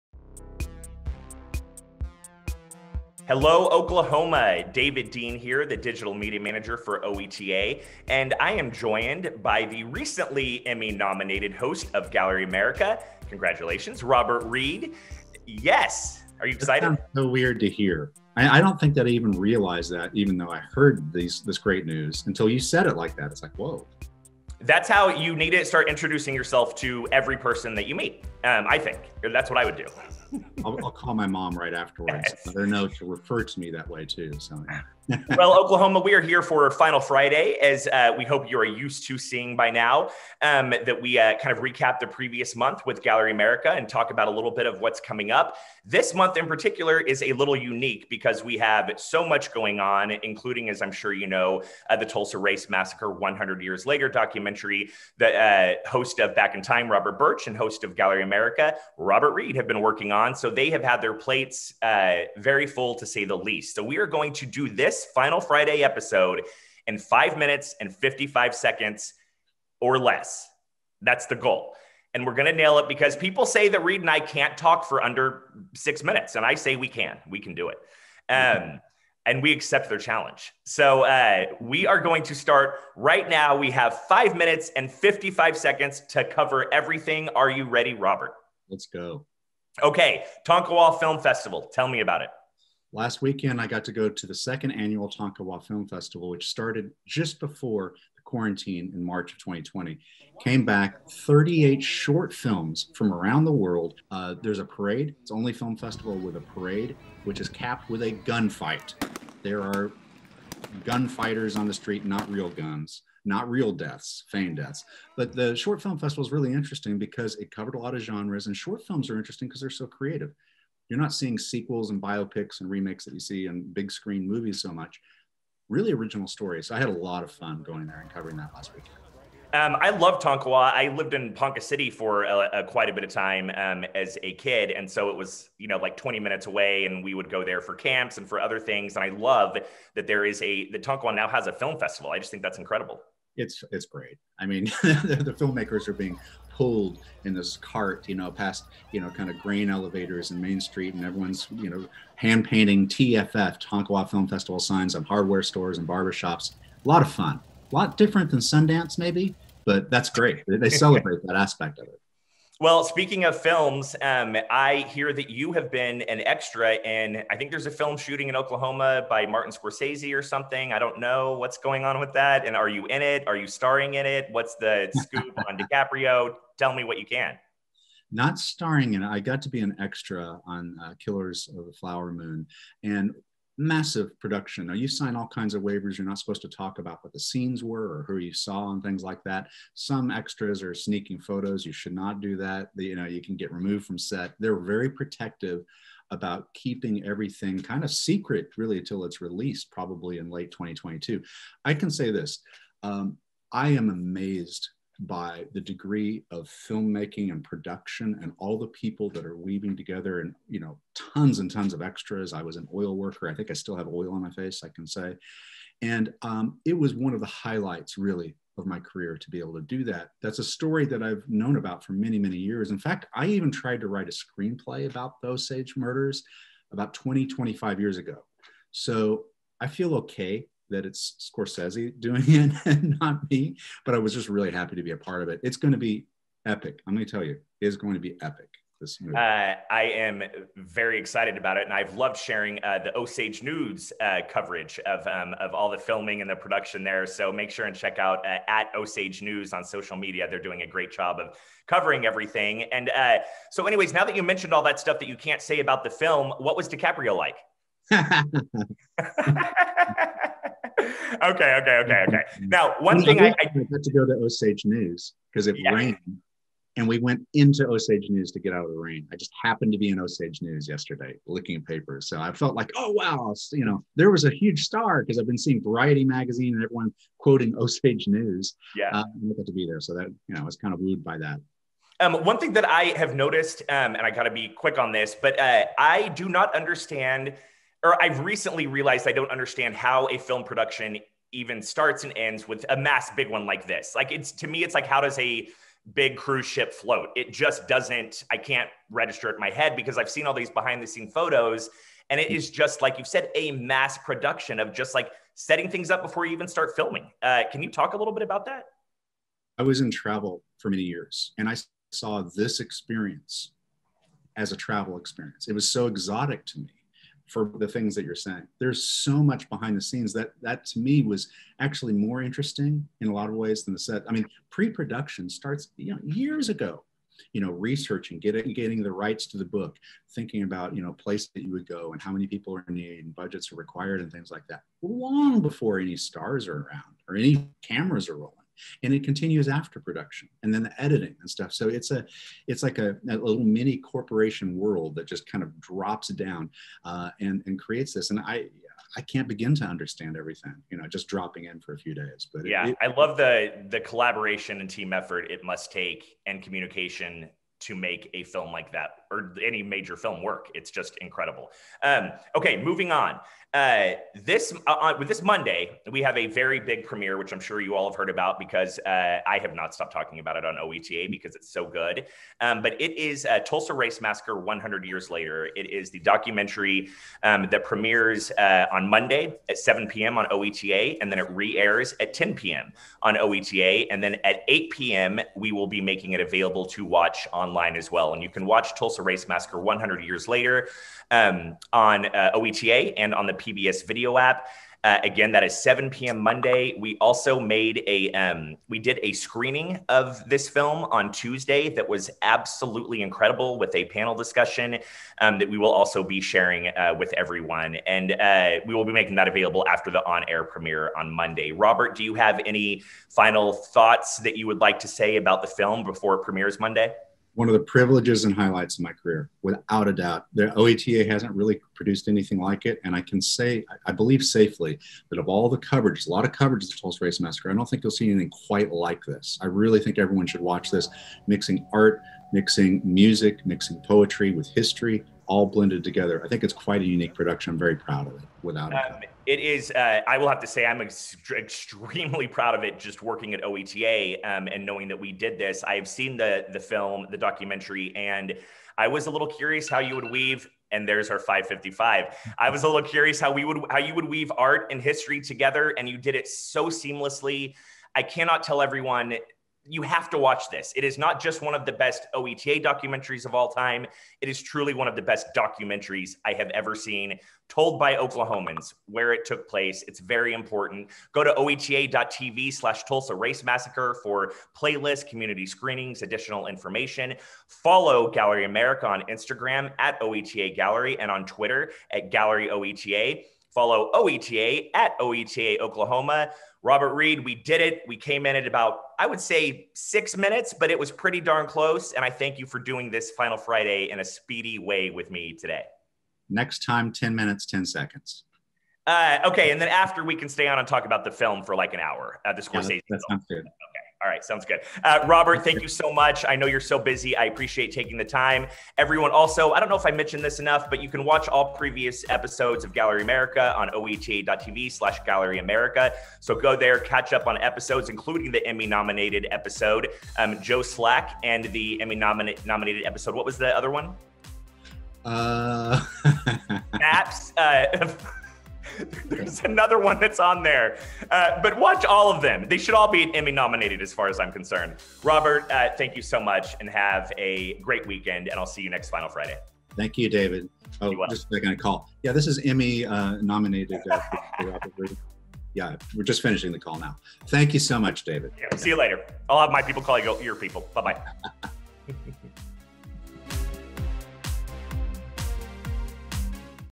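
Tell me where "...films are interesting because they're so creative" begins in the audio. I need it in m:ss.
1:58.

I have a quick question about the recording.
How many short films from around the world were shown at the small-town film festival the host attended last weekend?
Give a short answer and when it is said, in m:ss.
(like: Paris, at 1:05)
38, at 1:41.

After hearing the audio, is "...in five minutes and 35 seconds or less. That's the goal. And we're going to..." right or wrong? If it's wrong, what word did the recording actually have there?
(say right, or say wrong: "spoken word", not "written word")
wrong: "55", not "35".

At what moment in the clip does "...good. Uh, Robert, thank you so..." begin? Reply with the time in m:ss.
8:24.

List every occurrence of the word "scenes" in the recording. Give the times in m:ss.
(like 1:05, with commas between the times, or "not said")
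3:07, 5:00, 5:19.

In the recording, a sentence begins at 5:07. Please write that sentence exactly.
Uh, can you talk a little bit about that?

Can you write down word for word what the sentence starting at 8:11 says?
And I thank you for doing this Final Friday in a speedy way with me today.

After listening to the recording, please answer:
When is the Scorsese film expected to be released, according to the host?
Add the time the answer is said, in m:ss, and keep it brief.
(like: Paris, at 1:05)
Late 2022, at 3:20.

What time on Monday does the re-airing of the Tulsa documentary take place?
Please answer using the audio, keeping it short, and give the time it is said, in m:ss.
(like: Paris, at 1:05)
10 p.m., at 6:22.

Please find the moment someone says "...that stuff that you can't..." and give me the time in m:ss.
4:14.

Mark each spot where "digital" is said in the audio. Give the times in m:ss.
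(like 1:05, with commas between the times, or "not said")
0:05.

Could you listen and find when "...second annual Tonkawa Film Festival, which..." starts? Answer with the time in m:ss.
1:34.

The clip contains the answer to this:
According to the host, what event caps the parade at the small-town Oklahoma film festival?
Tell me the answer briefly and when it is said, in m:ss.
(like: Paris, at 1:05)
A gunfight, at 1:48.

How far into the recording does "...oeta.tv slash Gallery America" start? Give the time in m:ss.
8:33.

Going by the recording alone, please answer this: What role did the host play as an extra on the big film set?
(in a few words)
Oil worker.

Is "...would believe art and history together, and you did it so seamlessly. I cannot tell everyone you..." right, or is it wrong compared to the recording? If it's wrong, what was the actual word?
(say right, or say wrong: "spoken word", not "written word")
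wrong: "weave", not "believe".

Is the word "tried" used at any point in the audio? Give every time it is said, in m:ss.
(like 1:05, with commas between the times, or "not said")
3:43.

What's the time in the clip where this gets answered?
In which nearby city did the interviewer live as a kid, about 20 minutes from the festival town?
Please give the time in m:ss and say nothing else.
2:11.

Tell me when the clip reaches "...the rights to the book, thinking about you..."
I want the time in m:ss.
5:28.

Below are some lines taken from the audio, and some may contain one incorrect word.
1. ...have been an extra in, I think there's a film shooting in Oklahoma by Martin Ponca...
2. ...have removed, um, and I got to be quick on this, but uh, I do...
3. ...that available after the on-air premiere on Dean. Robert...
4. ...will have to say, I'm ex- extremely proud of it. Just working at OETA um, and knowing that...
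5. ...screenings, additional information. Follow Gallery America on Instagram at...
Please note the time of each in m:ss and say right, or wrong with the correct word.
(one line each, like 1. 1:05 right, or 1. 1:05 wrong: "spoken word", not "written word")
1. 2:45 wrong: "Scorsese", not "Ponca"
2. 4:42 wrong: "noticed", not "removed"
3. 6:49 wrong: "Monday", not "Dean"
4. 7:20 right
5. 7:55 right.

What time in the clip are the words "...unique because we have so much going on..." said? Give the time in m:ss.
0:47.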